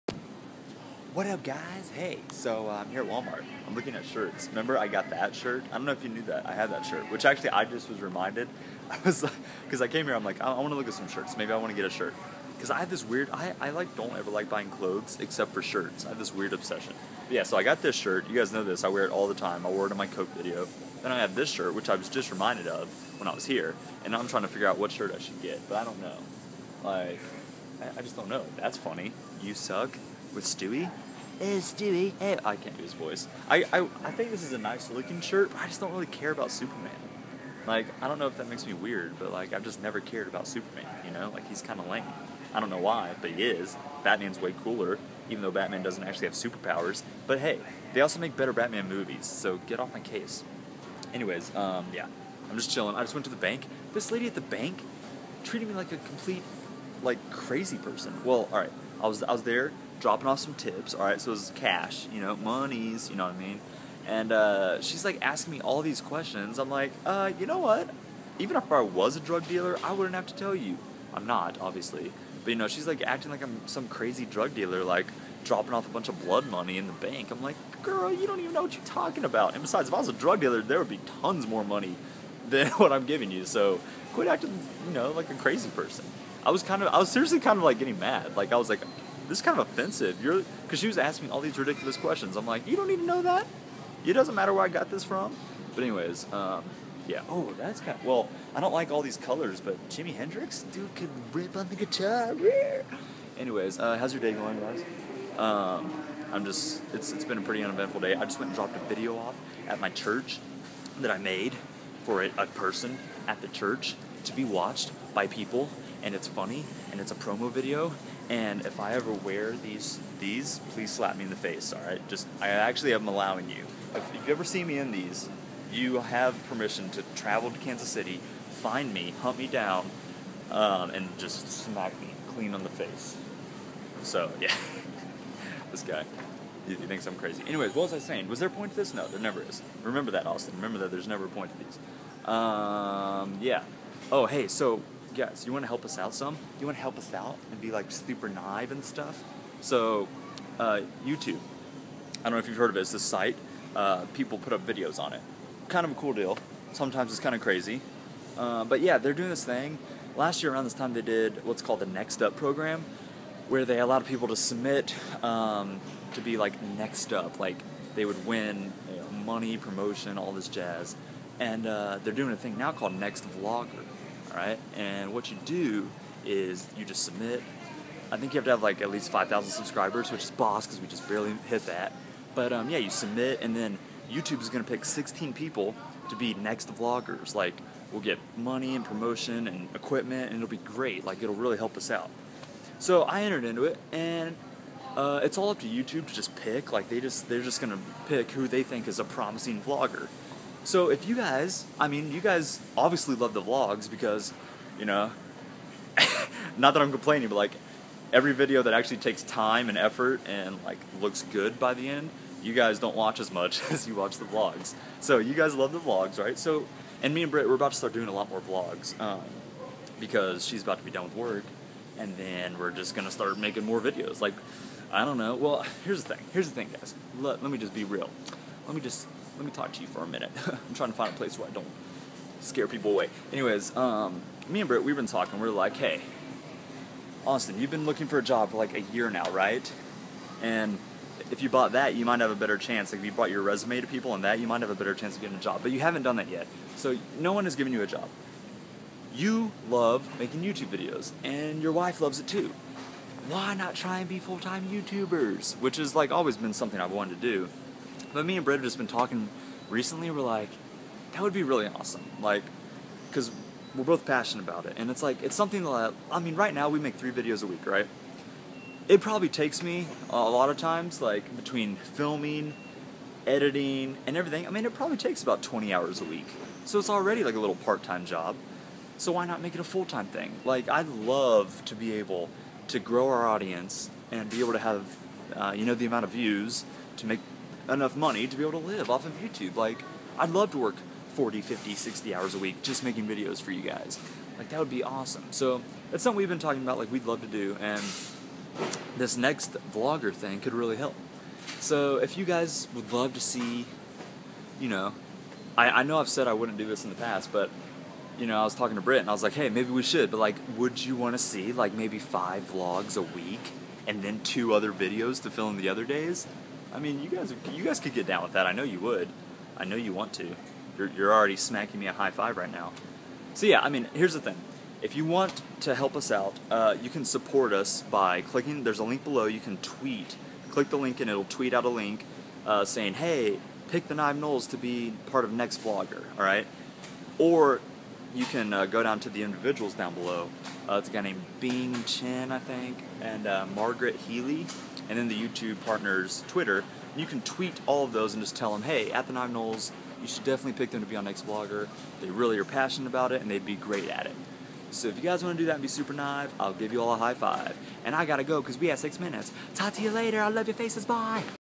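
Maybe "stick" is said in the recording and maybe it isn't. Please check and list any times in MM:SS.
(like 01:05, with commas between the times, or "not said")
not said.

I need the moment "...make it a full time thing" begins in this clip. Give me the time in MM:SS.
04:39.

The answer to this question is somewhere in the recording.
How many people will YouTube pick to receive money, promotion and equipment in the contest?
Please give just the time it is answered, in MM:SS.
03:04.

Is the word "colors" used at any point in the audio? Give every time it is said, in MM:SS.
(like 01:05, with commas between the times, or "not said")
01:39.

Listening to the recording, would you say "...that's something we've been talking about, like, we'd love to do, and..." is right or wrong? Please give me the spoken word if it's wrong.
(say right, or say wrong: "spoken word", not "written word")
right.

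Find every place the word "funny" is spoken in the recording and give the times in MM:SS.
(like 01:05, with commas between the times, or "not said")
00:28, 01:56.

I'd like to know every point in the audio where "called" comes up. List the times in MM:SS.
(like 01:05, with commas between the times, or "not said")
02:41, 02:52.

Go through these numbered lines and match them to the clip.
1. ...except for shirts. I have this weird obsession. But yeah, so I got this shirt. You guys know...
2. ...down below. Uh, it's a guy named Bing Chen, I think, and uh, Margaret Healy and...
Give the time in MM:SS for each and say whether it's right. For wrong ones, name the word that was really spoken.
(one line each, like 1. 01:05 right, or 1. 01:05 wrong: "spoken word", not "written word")
1. 00:15 right
2. 05:39 right.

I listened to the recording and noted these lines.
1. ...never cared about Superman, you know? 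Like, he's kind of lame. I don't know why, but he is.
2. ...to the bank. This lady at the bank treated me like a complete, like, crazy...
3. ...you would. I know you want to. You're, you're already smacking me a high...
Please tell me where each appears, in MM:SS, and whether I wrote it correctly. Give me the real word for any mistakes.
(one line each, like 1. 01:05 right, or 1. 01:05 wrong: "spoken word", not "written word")
1. 00:39 right
2. 00:53 right
3. 05:18 right.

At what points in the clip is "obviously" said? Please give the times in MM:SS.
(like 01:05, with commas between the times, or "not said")
01:11, 03:22.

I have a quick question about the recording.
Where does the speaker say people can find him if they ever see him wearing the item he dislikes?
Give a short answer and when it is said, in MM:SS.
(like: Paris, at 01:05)
Kansas City, at 02:07.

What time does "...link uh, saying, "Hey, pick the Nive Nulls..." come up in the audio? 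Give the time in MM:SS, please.
05:31.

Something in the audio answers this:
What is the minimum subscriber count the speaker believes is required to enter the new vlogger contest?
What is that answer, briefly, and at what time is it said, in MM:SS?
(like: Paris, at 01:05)
5,000, at 02:59.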